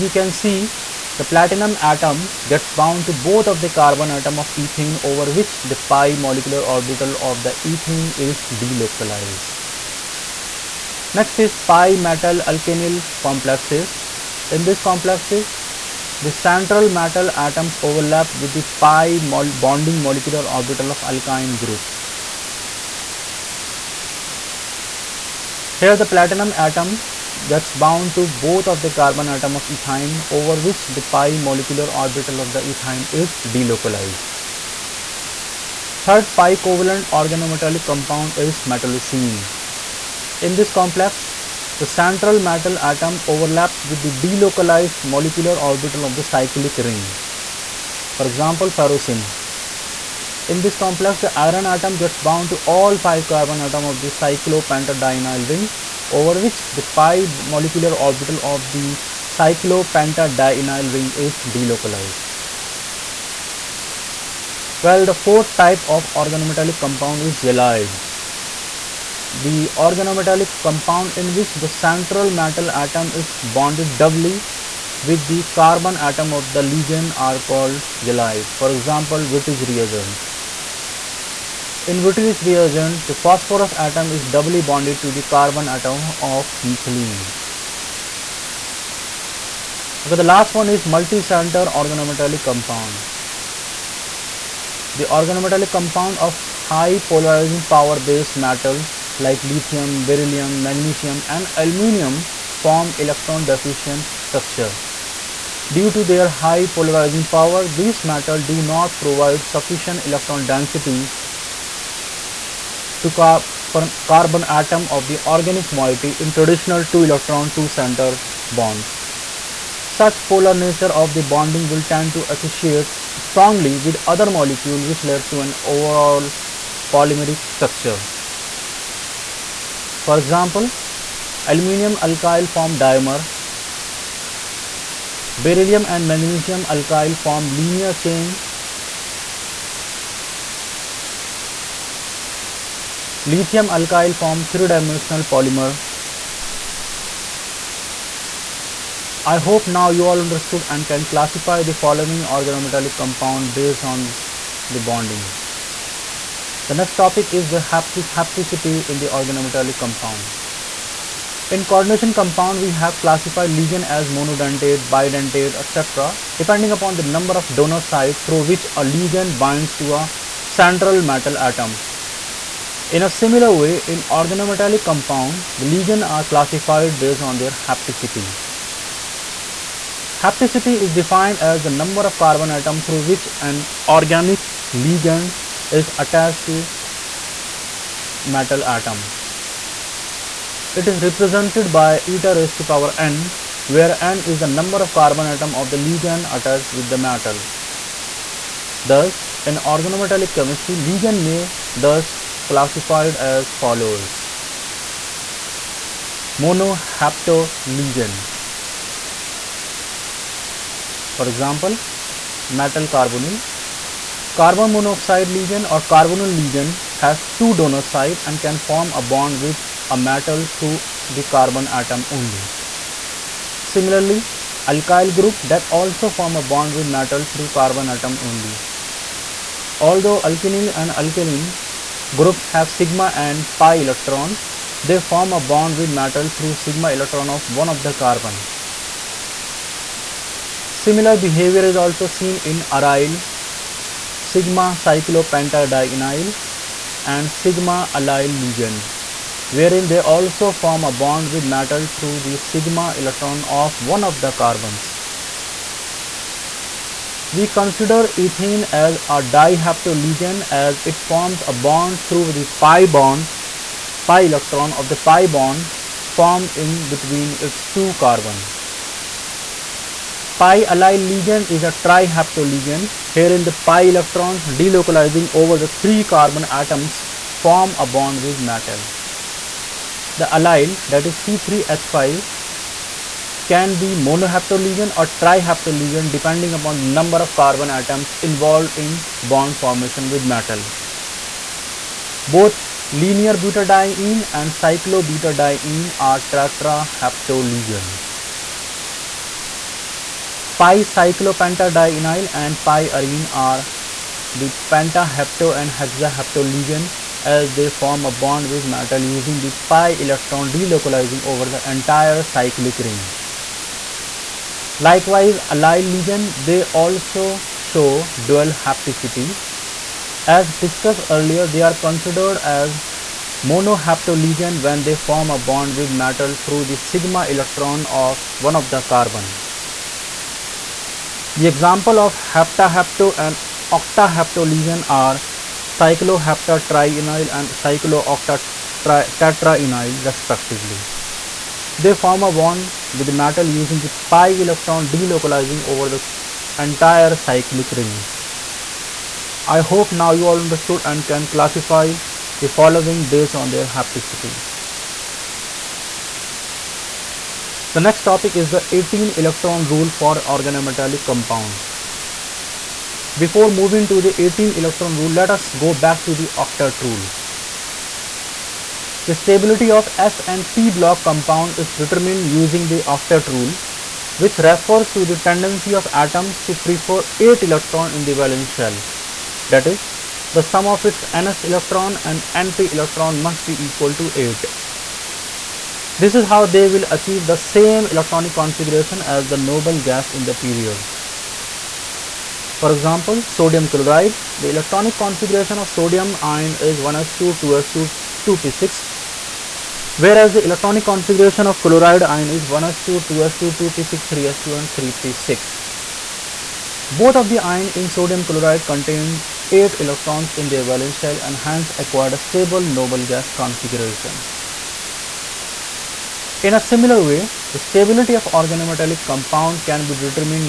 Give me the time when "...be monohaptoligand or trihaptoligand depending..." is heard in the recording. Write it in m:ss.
4:43.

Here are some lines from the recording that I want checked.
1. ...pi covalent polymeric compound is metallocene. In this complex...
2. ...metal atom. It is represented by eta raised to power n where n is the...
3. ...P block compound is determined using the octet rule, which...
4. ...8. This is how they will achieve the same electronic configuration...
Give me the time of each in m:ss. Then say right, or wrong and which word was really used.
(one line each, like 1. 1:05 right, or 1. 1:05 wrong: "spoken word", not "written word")
1. 0:36 wrong: "organometallic", not "polymeric"
2. 3:08 right
3. 6:10 right
4. 6:24 right.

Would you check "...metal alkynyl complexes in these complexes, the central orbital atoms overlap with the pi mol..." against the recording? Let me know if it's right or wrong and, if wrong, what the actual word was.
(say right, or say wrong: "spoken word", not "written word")
wrong: "metal", not "orbital".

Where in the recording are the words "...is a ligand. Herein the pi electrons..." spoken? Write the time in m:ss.
4:31.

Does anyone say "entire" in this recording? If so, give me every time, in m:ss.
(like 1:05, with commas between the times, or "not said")
5:11, 5:46.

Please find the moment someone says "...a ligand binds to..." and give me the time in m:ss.
2:48.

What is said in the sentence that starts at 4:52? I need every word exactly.
Both linear butadiene and cyclobutadiene are tetrahaptoligand.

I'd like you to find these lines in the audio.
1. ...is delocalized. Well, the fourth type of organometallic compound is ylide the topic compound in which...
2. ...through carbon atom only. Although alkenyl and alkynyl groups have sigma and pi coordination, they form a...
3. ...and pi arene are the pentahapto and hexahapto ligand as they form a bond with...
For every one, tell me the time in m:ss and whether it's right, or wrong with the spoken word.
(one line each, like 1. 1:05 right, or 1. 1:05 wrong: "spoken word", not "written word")
1. 1:01 wrong: "organometallic", not "topic"
2. 3:47 wrong: "electron", not "coordination"
3. 5:02 right.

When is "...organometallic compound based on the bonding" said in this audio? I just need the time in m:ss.
2:32.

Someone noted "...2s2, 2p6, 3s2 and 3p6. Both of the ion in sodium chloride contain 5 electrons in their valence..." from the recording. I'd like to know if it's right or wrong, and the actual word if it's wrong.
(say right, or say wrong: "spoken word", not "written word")
wrong: "8", not "5".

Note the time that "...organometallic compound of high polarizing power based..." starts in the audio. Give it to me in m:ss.
1:35.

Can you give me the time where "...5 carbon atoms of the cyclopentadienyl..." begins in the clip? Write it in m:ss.
0:52.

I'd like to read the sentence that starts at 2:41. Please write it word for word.
In coordination compound, we have classified ligand as monodentate, bidentate, etc.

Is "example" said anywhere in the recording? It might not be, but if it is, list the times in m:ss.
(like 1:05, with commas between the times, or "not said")
0:48, 1:18, 2:10, 3:31, 5:31, 6:32.